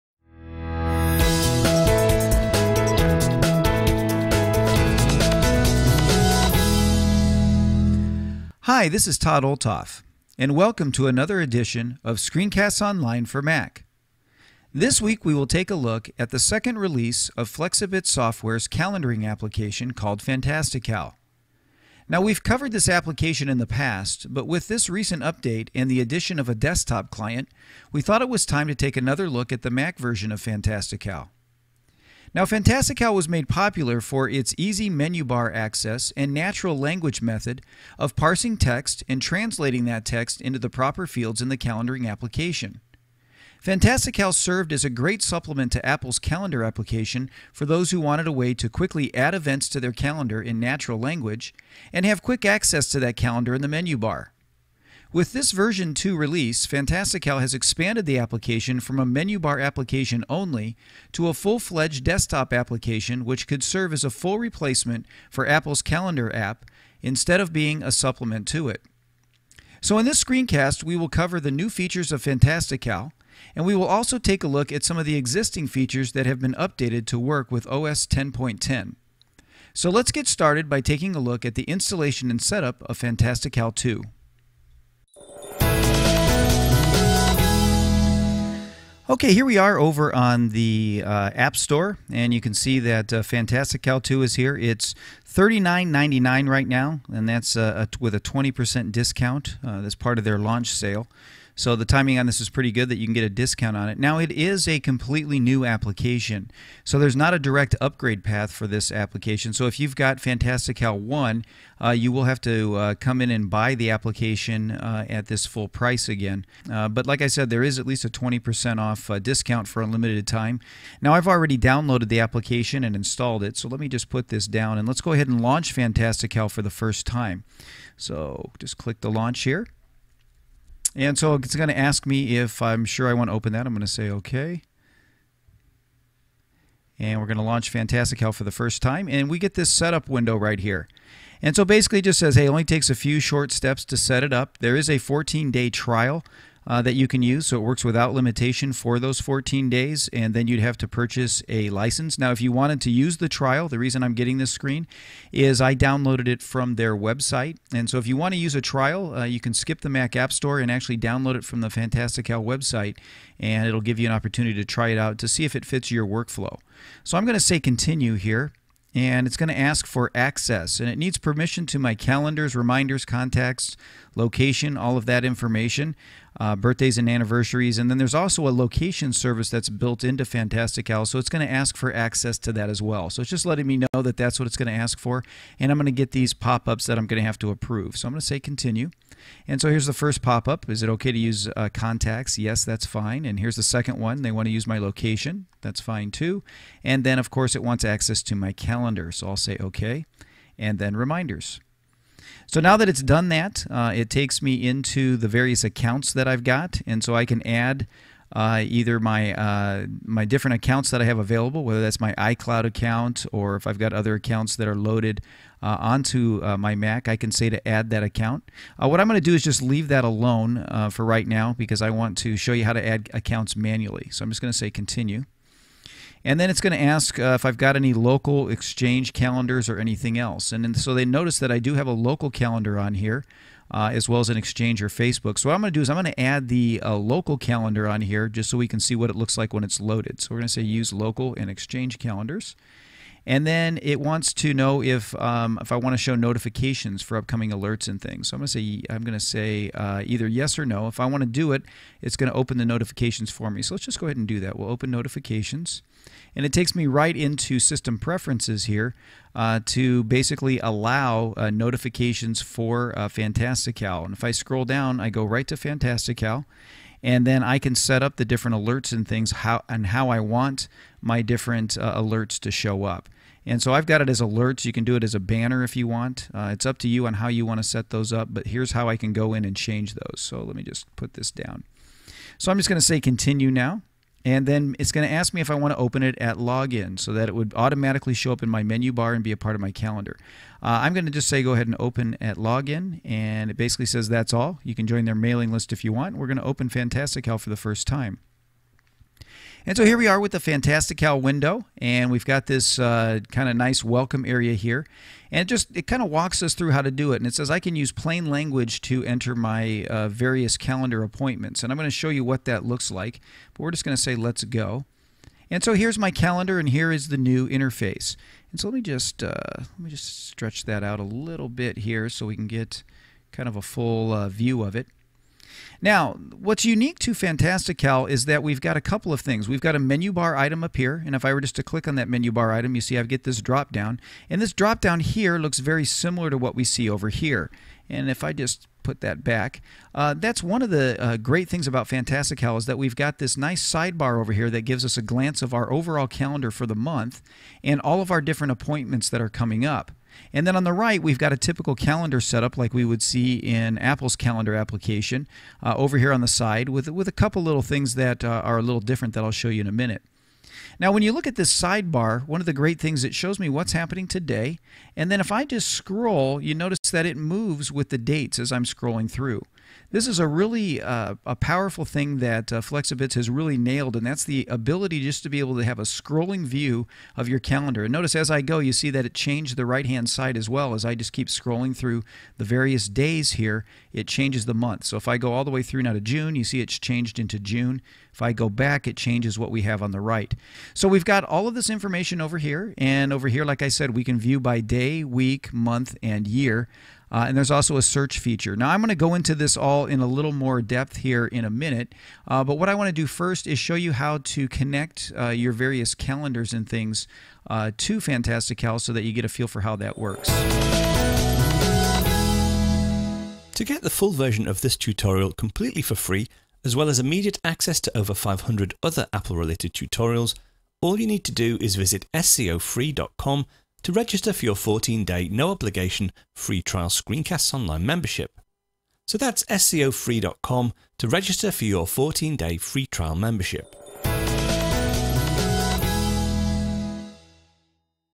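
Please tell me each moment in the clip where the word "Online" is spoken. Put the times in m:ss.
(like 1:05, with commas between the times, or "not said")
0:12, 7:07.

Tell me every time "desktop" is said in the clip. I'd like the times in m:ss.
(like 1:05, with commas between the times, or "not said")
0:26, 1:02.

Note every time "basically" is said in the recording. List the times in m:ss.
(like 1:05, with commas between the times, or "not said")
2:21, 4:20, 4:53.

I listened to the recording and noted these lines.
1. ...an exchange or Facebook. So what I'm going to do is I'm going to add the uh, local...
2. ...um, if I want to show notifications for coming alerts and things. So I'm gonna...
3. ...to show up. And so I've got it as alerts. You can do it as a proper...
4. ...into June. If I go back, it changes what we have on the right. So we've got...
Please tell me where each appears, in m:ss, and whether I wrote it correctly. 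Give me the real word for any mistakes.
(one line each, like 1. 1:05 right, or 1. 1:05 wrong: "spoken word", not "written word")
1. 3:54 right
2. 4:05 wrong: "upcoming", not "coming"
3. 4:32 wrong: "banner", not "proper"
4. 6:27 right.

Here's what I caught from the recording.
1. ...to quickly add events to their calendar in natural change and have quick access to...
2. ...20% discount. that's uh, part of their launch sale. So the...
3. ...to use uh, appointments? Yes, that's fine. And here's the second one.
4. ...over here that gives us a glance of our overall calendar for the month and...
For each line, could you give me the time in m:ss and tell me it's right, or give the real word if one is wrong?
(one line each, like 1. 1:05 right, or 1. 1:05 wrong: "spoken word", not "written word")
1. 0:48 wrong: "language", not "change"
2. 1:38 right
3. 3:11 wrong: "contacts", not "appointments"
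4. 5:44 right.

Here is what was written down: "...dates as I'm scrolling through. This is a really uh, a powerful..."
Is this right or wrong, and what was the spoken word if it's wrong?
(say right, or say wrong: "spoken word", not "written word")
right.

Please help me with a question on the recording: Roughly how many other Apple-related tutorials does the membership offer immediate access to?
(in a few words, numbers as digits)
500.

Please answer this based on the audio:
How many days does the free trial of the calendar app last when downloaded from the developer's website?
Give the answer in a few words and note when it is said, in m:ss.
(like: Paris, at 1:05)
14, at 2:24.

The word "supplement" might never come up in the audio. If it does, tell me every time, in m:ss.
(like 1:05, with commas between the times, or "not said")
0:45, 1:07.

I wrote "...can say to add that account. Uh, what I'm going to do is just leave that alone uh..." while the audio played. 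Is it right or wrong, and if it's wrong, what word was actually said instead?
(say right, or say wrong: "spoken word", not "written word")
right.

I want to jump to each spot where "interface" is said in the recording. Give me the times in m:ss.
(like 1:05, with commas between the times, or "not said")
5:17.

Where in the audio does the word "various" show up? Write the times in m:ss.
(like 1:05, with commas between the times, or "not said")
3:25, 5:10, 6:22, 6:45.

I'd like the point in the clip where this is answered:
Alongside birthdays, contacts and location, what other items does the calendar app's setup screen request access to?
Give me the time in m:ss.
2:57.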